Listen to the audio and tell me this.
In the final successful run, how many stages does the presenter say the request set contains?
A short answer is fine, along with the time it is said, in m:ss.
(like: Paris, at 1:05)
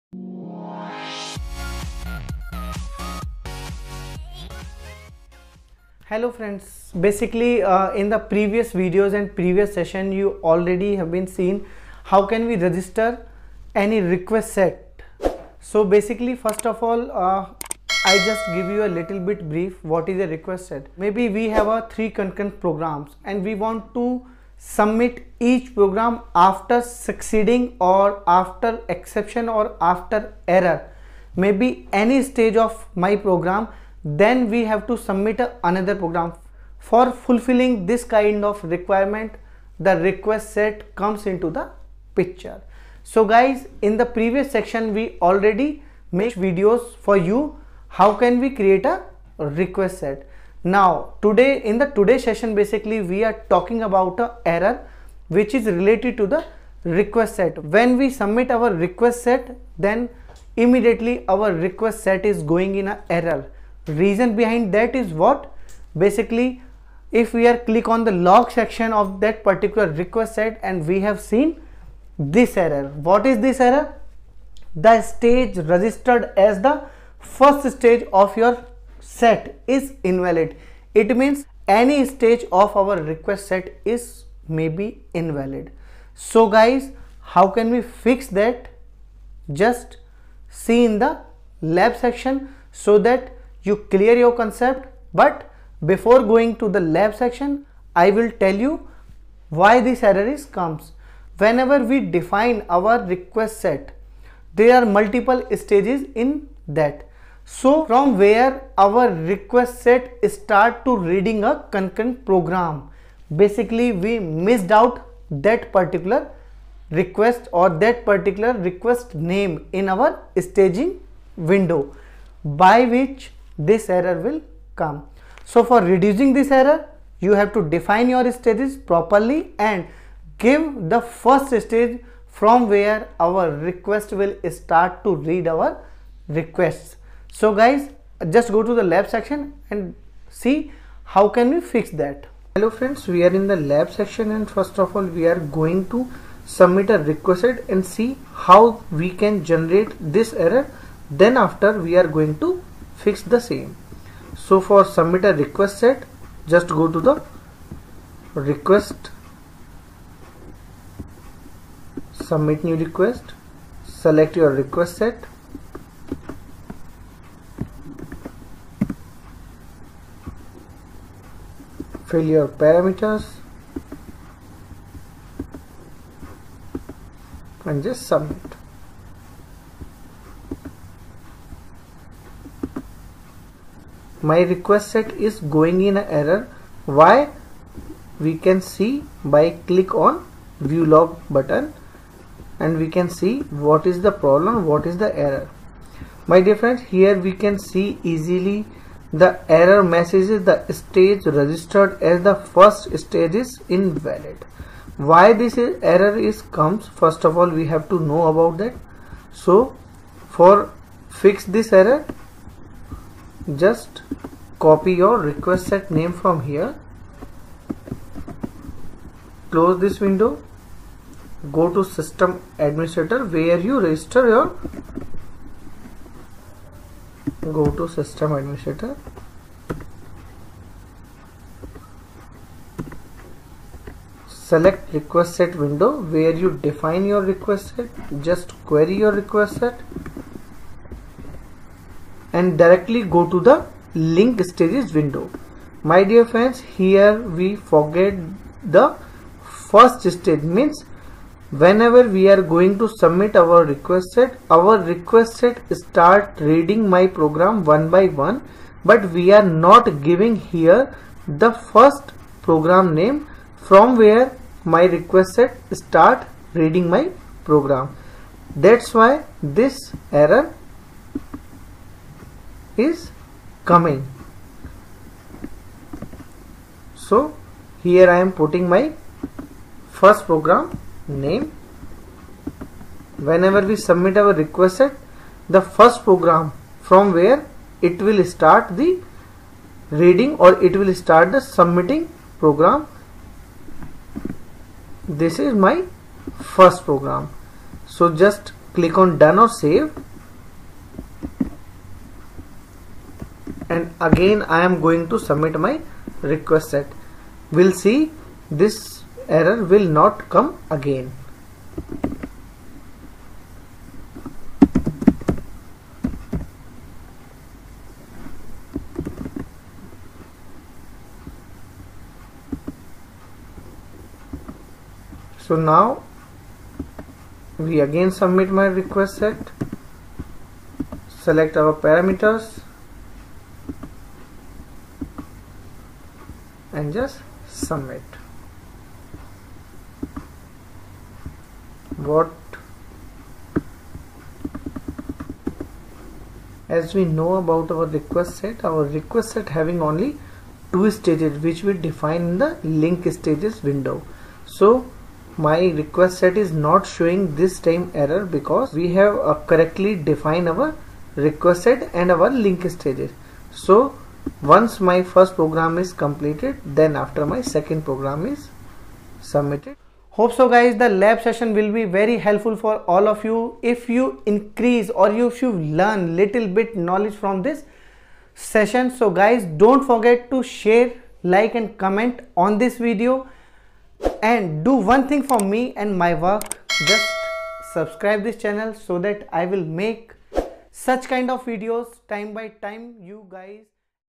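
2, at 5:50.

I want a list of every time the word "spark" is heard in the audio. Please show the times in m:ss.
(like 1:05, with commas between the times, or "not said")
not said.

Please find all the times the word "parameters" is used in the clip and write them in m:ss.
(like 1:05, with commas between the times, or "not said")
2:52, 5:31.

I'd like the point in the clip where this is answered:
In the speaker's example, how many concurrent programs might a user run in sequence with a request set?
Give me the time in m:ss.
0:21.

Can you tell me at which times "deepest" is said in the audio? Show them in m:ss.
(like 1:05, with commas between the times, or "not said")
not said.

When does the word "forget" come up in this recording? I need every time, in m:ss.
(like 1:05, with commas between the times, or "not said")
4:07, 6:19.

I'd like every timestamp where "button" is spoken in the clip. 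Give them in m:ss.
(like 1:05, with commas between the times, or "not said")
3:11.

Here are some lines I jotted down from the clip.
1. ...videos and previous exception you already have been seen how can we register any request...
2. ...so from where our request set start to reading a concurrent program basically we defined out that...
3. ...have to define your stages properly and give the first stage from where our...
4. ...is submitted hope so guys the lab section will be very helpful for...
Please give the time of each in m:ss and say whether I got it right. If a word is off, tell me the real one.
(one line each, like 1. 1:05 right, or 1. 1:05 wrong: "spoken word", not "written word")
1. 0:08 wrong: "session", not "exception"
2. 1:47 wrong: "missed", not "defined"
3. 2:07 right
4. 6:08 wrong: "session", not "section".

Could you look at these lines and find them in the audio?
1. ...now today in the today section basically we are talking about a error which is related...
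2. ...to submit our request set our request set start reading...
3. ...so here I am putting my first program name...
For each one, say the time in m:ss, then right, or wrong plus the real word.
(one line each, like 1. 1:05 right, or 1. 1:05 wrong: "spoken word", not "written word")
1. 0:50 wrong: "session", not "section"
2. 4:12 right
3. 4:37 right.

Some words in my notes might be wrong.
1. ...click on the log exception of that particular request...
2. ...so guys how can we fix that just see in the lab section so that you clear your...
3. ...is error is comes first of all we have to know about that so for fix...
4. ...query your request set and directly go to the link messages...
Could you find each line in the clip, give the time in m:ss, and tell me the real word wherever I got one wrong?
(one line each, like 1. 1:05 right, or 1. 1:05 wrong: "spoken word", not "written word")
1. 1:07 wrong: "section", not "exception"
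2. 1:26 right
3. 3:25 right
4. 3:58 wrong: "stages", not "messages".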